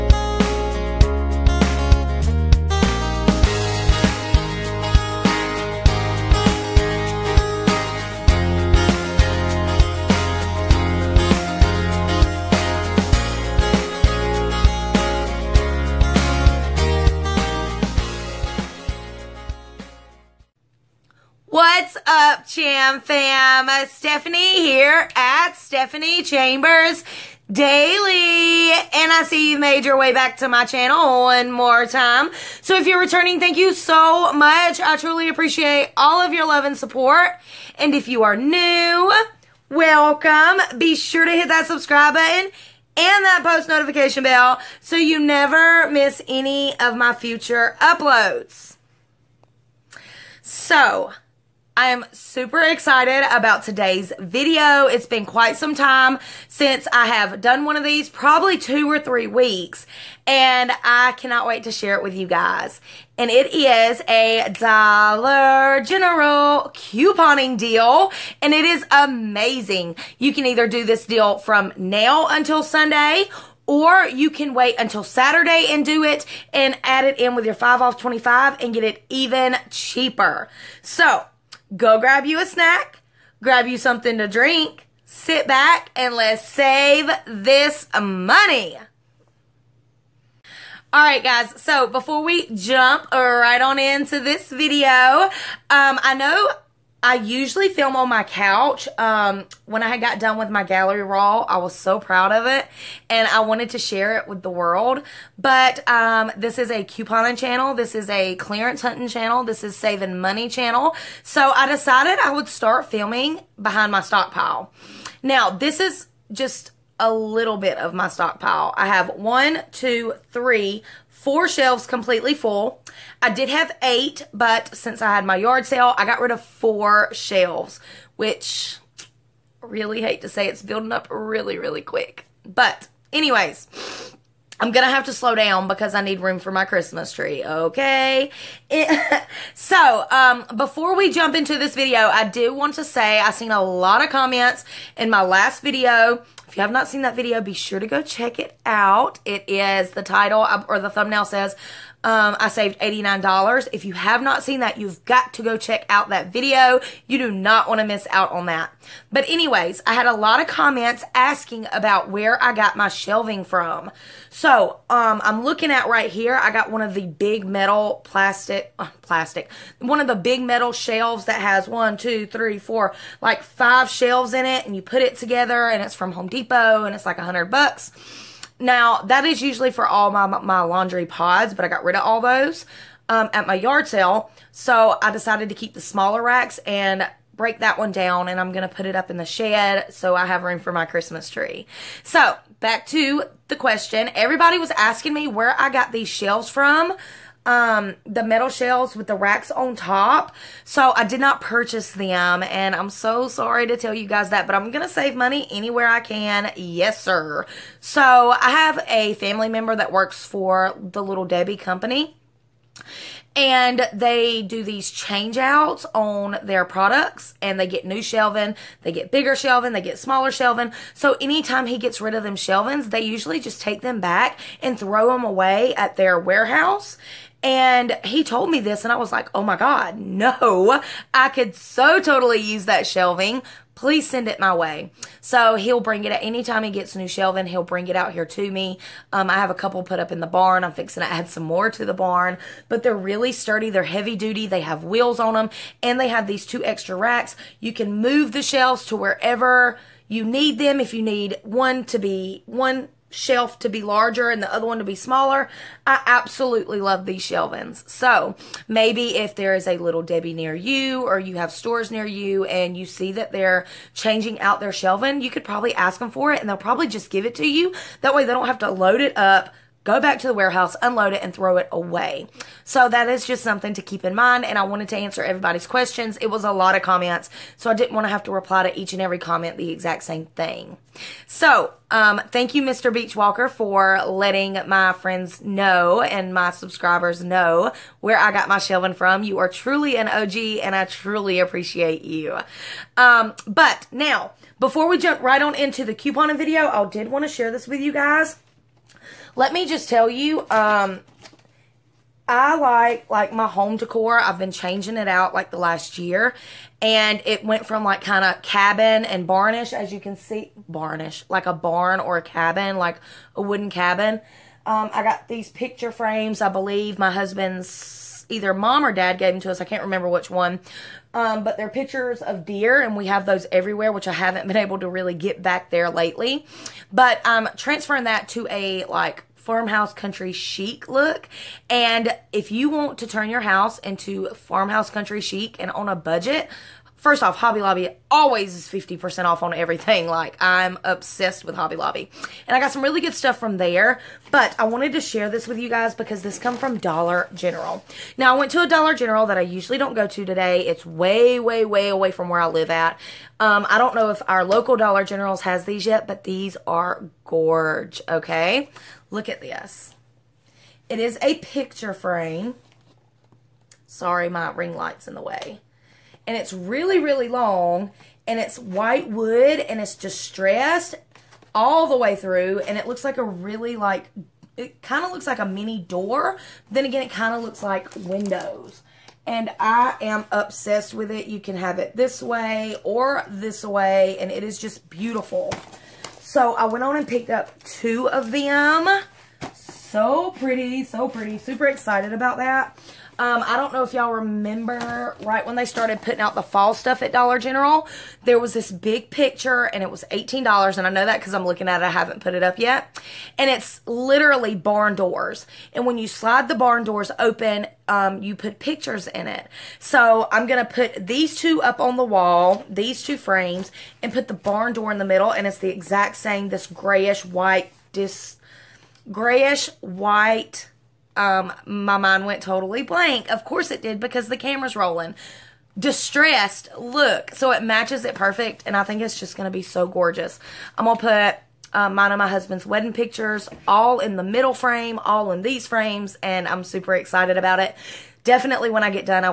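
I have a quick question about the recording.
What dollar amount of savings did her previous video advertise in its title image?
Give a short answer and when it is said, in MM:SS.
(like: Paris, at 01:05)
$89, at 02:32.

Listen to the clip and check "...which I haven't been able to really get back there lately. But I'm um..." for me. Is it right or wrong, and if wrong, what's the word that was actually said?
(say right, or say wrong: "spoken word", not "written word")
right.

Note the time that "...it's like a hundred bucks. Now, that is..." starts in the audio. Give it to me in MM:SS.
02:56.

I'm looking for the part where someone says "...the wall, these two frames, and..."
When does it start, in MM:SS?
06:51.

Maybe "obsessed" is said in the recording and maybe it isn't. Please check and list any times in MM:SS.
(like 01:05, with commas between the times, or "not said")
05:40, 06:20.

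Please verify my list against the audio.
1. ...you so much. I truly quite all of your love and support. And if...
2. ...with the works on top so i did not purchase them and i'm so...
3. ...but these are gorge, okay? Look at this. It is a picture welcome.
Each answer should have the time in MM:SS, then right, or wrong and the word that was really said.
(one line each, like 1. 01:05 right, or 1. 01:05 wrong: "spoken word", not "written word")
1. 00:33 wrong: "appreciate", not "quite"
2. 03:18 wrong: "racks", not "works"
3. 05:56 wrong: "frame", not "welcome".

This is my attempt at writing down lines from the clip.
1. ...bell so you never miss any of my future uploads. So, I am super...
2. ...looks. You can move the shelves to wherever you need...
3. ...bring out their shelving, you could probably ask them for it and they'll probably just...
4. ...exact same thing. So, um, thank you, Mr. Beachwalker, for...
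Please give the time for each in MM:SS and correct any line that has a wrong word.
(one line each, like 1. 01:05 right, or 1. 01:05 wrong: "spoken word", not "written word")
1. 00:44 right
2. 04:06 wrong: "racks", not "looks"
3. 04:23 wrong: "changing", not "bring"
4. 04:39 right.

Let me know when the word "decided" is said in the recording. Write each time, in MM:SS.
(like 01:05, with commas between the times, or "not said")
01:51, 03:05.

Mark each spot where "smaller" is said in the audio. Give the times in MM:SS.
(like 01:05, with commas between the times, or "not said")
03:05, 03:39, 04:14.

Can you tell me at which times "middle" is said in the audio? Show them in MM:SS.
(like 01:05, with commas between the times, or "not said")
06:55, 07:14.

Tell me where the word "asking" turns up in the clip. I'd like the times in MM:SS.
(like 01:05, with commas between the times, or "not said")
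02:41, 03:14.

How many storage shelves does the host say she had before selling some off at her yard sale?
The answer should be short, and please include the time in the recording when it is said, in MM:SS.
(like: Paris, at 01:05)
8, at 02:03.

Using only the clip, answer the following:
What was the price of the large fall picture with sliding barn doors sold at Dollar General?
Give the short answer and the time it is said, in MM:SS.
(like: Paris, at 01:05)
$18, at 06:40.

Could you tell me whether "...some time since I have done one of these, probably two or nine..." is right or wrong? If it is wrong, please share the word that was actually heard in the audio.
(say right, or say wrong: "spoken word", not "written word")
wrong: "three", not "nine".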